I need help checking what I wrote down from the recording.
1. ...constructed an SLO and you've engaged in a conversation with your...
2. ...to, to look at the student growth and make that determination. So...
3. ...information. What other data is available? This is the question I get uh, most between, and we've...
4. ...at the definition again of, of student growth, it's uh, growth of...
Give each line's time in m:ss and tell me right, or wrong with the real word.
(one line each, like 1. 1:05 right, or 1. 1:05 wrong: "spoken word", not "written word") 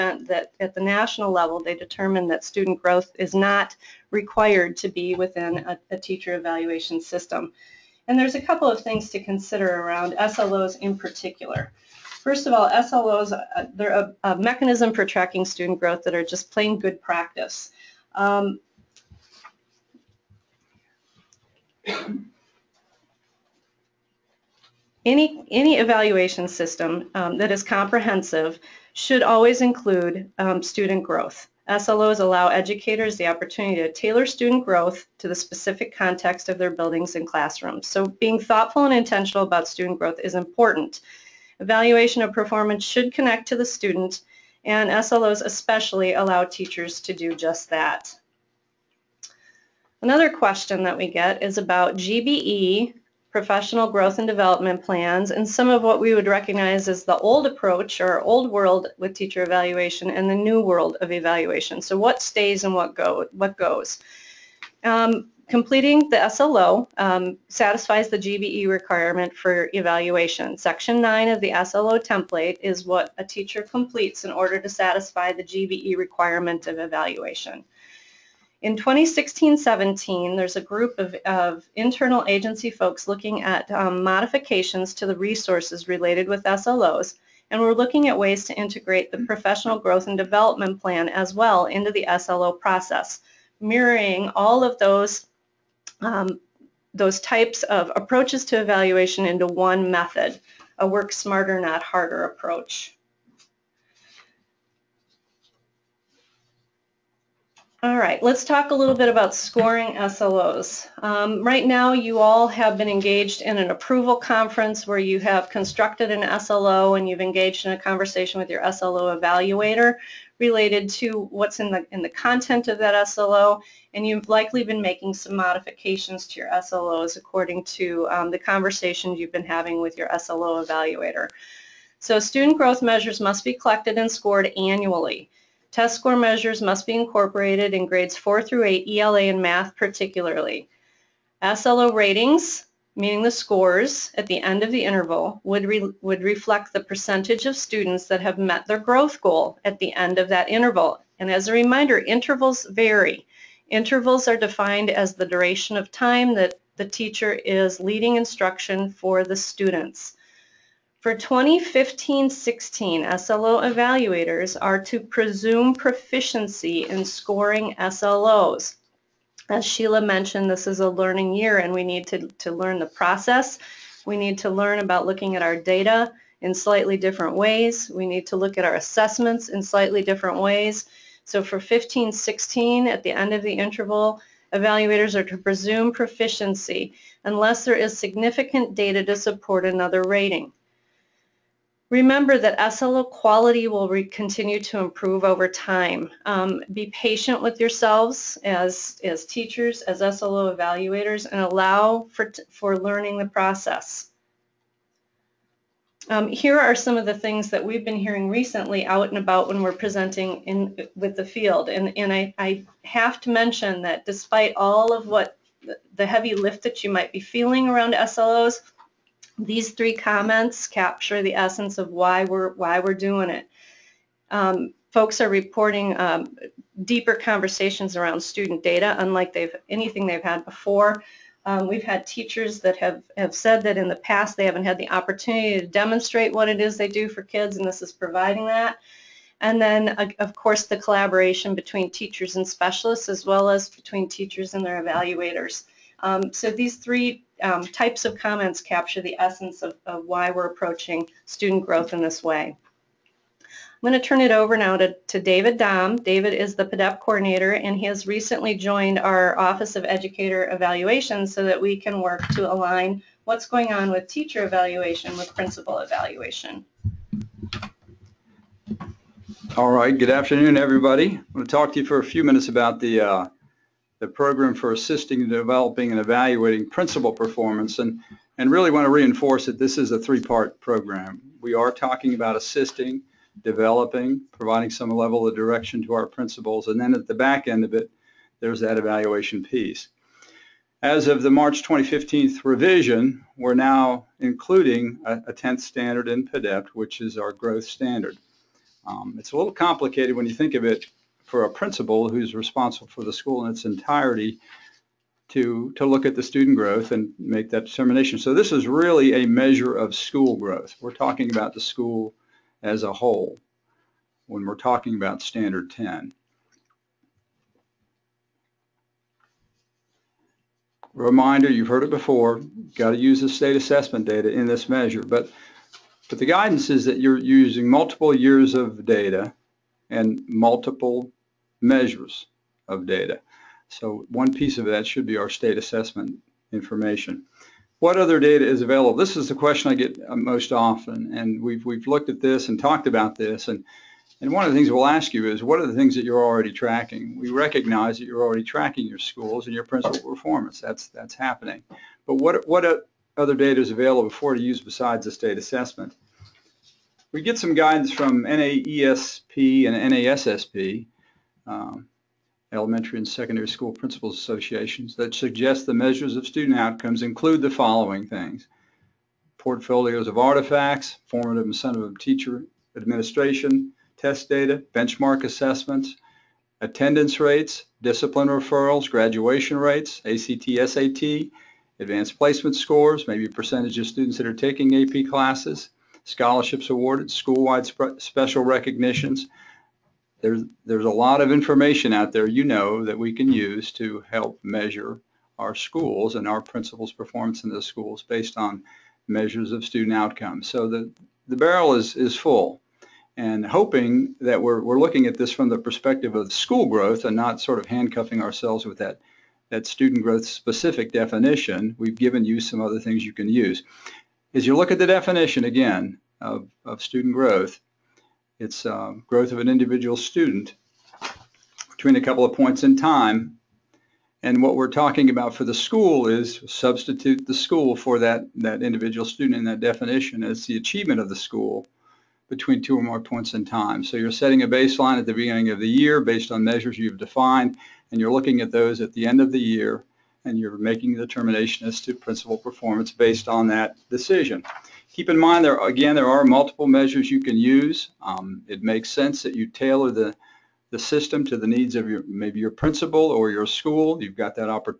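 1. 1:55 right
2. 5:05 right
3. 5:36 wrong: "often", not "between"
4. 6:54 right.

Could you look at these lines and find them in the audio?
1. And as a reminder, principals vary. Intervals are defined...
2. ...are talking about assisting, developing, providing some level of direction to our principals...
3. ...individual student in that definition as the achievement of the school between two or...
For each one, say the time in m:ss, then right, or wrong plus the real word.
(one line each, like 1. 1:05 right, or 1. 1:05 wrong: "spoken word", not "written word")
1. 2:31 wrong: "intervals", not "principals"
2. 4:41 right
3. 7:08 right.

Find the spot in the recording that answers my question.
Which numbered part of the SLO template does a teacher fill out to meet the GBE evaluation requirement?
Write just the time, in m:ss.
1:10.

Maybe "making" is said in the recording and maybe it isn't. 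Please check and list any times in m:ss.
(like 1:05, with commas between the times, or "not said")
2:04, 7:20.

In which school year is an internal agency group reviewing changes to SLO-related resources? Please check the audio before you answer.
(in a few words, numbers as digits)
2016-17.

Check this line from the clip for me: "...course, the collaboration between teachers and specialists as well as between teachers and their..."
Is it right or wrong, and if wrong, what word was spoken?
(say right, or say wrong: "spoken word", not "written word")
right.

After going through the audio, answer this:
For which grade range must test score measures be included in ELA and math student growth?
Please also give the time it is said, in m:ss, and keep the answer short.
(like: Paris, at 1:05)
4 through 8, at 2:18.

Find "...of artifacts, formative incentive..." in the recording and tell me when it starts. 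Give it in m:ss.
6:10.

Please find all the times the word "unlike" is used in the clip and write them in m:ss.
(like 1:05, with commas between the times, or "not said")
3:48.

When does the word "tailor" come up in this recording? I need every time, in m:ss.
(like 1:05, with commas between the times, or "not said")
0:33, 7:29.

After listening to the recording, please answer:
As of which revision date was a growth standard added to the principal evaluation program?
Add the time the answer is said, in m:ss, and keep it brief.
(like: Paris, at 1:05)
March 2015, at 4:51.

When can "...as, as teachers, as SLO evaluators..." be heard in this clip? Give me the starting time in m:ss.
3:18.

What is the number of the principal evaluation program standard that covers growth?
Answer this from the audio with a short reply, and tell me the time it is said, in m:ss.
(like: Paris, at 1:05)
10th, at 4:55.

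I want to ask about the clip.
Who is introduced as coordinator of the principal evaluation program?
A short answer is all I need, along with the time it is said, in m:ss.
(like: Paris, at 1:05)
David Dom, at 4:15.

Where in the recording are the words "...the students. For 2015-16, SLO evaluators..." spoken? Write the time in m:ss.
2:39.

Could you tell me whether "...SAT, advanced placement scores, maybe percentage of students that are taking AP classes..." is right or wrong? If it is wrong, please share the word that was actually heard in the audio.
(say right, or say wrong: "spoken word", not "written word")
right.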